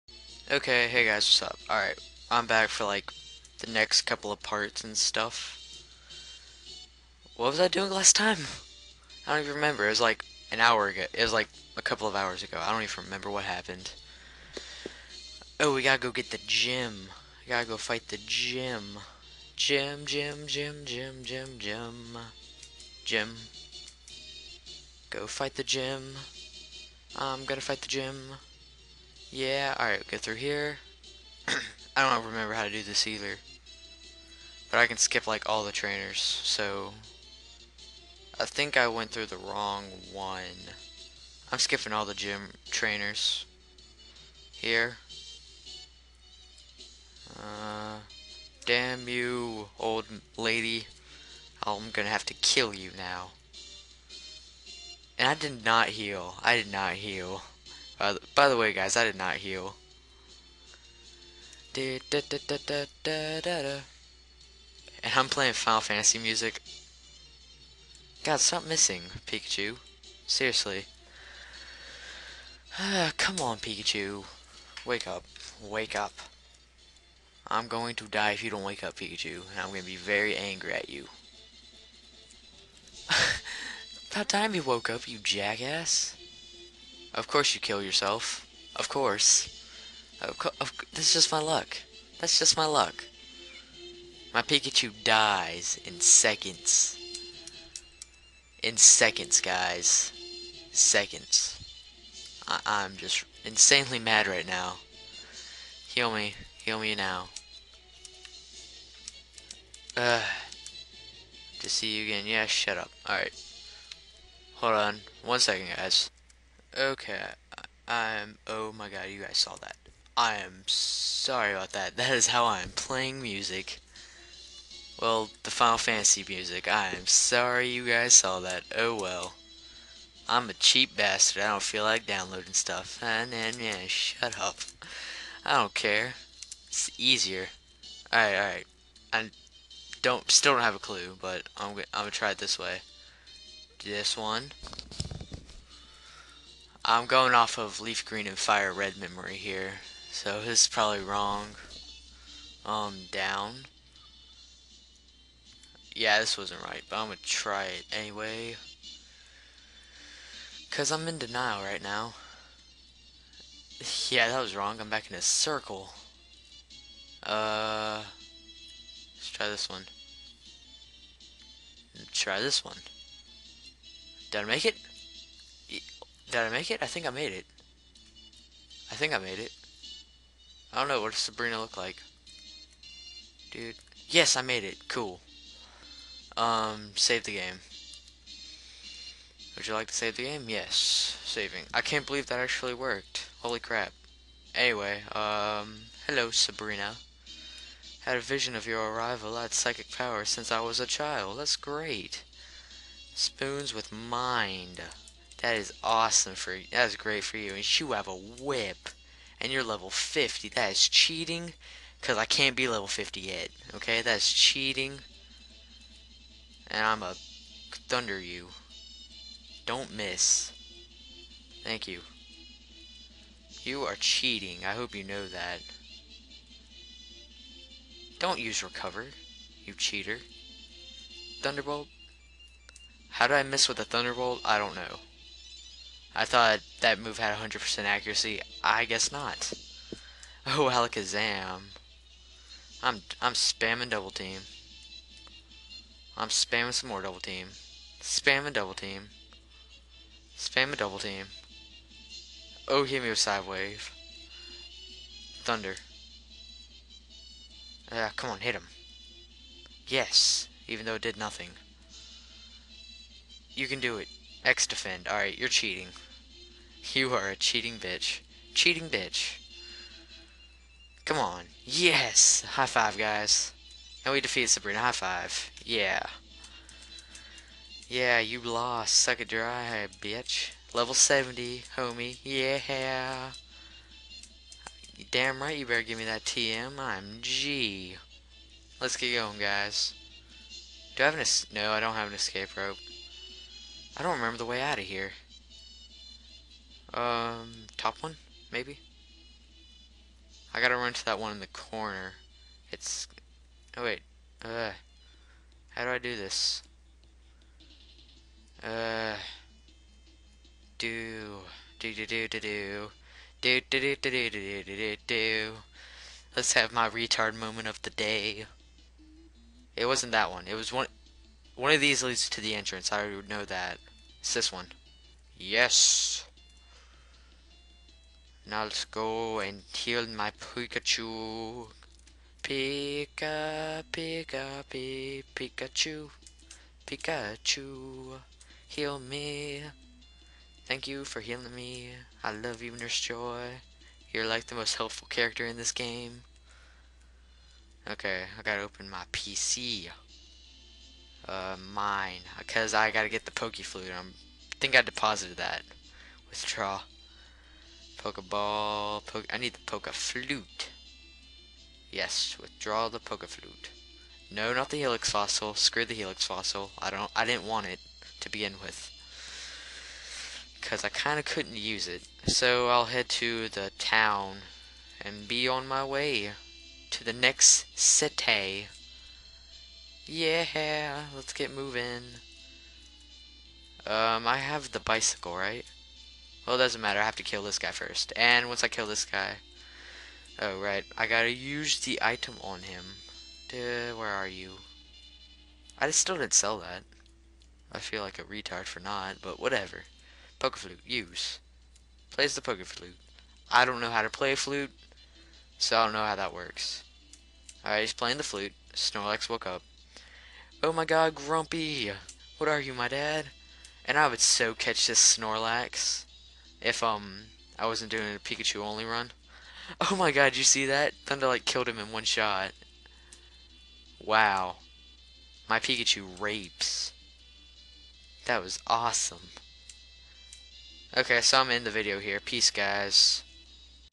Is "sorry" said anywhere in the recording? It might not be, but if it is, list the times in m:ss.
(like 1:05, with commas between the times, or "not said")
2:00, 2:07.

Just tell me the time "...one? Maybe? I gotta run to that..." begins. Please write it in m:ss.
4:58.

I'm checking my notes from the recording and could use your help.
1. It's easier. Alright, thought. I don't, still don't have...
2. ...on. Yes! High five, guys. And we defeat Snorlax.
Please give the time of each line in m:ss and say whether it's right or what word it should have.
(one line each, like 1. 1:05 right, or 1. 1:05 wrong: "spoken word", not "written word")
1. 2:16 wrong: "alright", not "thought"
2. 4:31 wrong: "Sabrina", not "Snorlax".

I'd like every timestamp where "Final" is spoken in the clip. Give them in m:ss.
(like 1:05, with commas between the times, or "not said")
1:05, 2:05.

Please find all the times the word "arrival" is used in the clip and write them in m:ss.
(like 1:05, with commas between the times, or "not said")
3:18.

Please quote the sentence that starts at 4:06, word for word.
I'm spamming some more double team.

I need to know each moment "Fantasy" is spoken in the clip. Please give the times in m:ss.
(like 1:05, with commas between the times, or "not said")
1:05, 2:05.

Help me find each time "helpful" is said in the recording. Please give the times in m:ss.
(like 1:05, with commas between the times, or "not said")
5:44.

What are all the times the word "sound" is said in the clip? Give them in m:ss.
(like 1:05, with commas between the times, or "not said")
not said.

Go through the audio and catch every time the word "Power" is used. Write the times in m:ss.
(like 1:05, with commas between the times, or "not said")
3:19.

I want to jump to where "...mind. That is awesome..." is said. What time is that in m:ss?
3:23.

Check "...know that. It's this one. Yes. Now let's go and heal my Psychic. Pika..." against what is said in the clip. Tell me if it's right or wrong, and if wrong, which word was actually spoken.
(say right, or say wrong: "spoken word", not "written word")
wrong: "Pikachu", not "Psychic".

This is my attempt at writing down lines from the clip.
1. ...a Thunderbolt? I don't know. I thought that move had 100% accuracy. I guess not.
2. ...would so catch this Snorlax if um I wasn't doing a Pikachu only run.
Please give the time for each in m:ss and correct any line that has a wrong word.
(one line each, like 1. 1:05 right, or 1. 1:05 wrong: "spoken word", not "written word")
1. 3:53 right
2. 6:54 right.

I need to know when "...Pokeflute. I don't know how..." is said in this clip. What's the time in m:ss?
6:42.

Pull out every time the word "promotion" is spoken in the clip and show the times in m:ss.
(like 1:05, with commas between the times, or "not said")
not said.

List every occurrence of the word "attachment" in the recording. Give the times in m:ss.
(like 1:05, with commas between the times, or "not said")
not said.